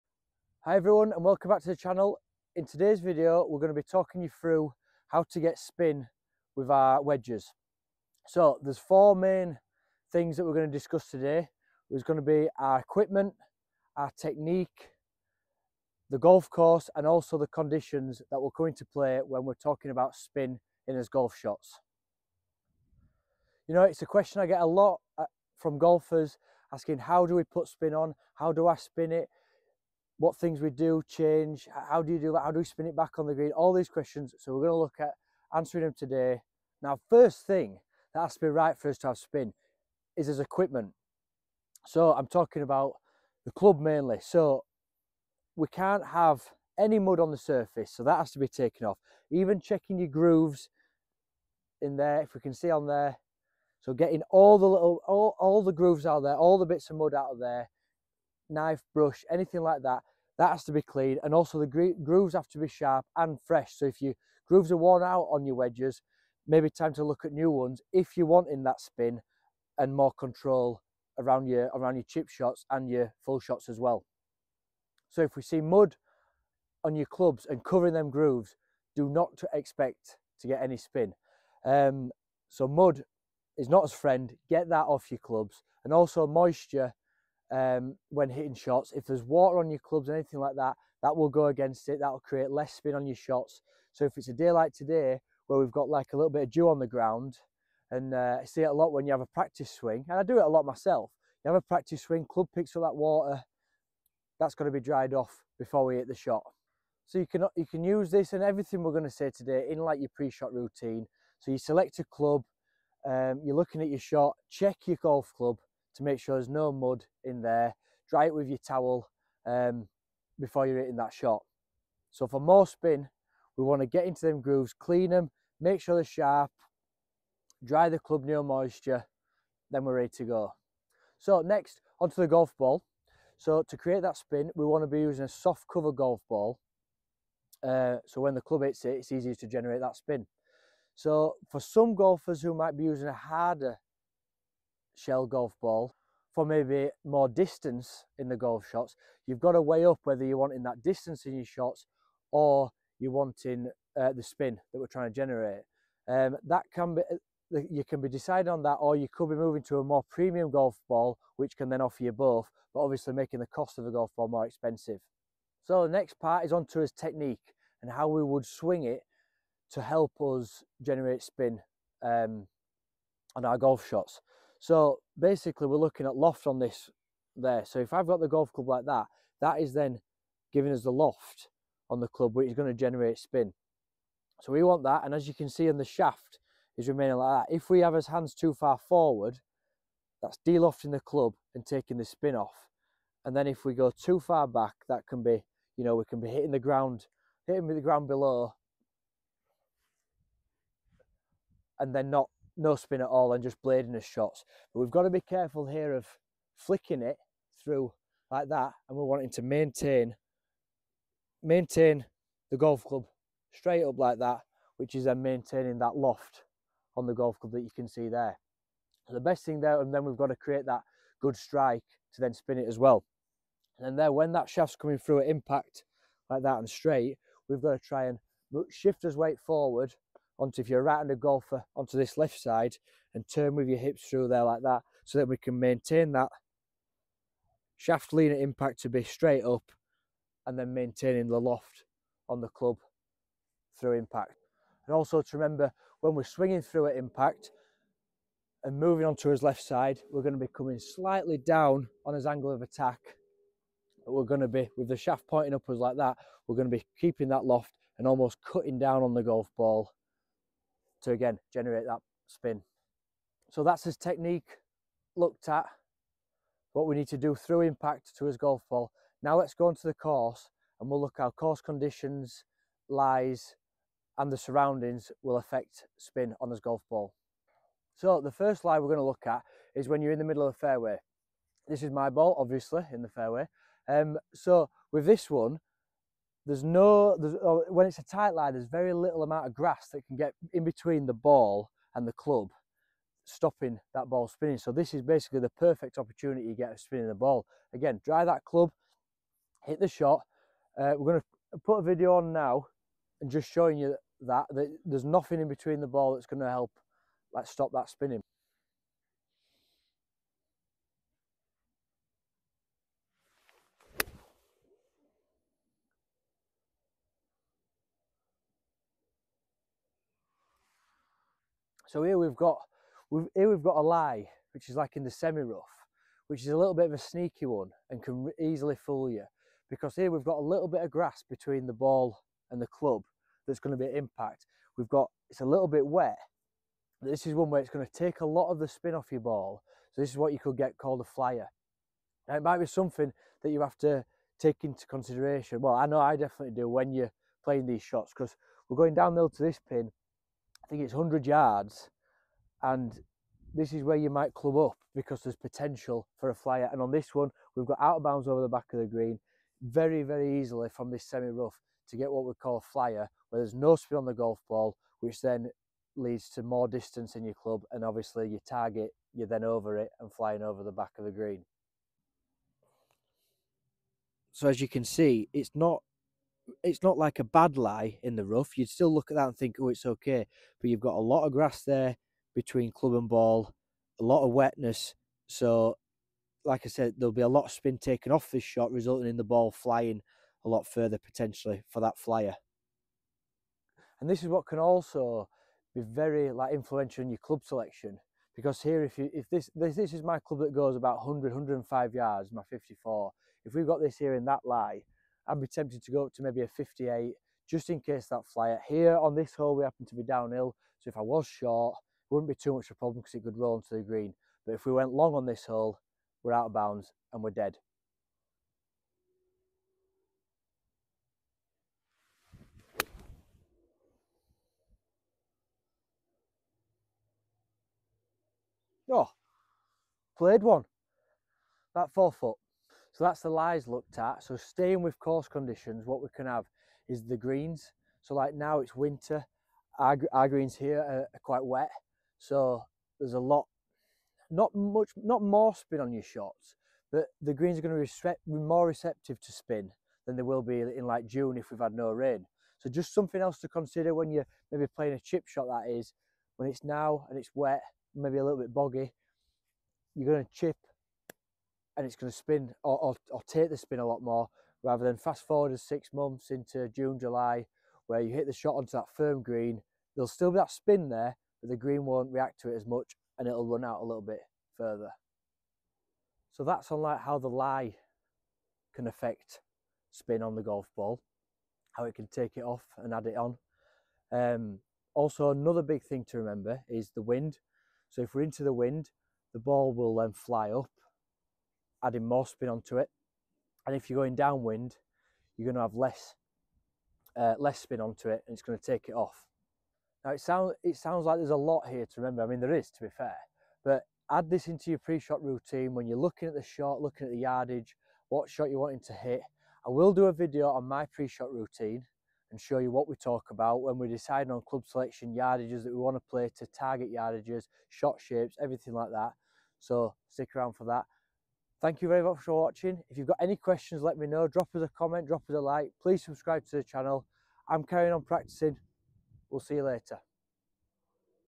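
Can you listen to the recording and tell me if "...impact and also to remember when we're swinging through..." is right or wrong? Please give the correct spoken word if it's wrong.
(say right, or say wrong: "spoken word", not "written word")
right.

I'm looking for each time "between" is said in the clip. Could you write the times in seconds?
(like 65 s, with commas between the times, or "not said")
290 s, 305 s, 331 s, 382 s.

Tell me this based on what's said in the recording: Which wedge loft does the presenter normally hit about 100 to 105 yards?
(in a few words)
54.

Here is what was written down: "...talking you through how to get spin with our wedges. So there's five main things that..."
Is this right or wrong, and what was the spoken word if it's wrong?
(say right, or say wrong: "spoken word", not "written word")
wrong: "four", not "five".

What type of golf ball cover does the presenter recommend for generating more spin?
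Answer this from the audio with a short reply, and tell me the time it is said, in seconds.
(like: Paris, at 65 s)
Soft cover, at 135 s.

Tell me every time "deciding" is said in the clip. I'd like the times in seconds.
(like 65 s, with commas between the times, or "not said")
158 s, 513 s.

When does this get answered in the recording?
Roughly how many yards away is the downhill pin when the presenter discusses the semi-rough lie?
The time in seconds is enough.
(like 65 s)
350 s.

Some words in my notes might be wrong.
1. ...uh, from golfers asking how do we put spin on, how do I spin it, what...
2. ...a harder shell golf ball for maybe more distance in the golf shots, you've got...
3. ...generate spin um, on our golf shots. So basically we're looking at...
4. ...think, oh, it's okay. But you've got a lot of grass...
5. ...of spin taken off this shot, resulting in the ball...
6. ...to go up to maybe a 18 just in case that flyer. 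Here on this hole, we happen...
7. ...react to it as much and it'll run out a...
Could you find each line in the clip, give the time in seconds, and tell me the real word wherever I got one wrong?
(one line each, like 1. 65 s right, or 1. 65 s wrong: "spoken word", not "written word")
1. 25 s right
2. 143 s right
3. 170 s right
4. 379 s right
5. 387 s right
6. 405 s wrong: "58", not "18"
7. 472 s right.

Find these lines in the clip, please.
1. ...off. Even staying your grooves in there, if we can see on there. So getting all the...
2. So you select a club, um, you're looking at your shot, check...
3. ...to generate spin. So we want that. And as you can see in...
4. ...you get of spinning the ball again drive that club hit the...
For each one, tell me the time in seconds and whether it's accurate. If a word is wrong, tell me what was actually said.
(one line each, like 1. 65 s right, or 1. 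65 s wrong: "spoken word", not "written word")
1. 48 s wrong: "checking", not "staying"
2. 111 s right
3. 182 s right
4. 296 s right.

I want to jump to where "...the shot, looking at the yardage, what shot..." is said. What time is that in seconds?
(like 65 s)
506 s.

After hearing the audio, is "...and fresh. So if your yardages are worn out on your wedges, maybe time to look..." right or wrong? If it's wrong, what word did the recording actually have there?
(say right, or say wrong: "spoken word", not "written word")
wrong: "grooves", not "yardages".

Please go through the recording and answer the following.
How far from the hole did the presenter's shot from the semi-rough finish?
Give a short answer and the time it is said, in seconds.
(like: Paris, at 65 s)
4 feet, at 431 s.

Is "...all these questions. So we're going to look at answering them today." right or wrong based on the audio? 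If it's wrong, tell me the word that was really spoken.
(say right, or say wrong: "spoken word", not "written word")
right.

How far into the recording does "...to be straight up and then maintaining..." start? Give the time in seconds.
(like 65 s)
238 s.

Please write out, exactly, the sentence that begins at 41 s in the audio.
So I'm talking about the club mainly.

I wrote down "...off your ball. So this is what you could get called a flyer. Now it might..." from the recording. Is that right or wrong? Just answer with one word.
right.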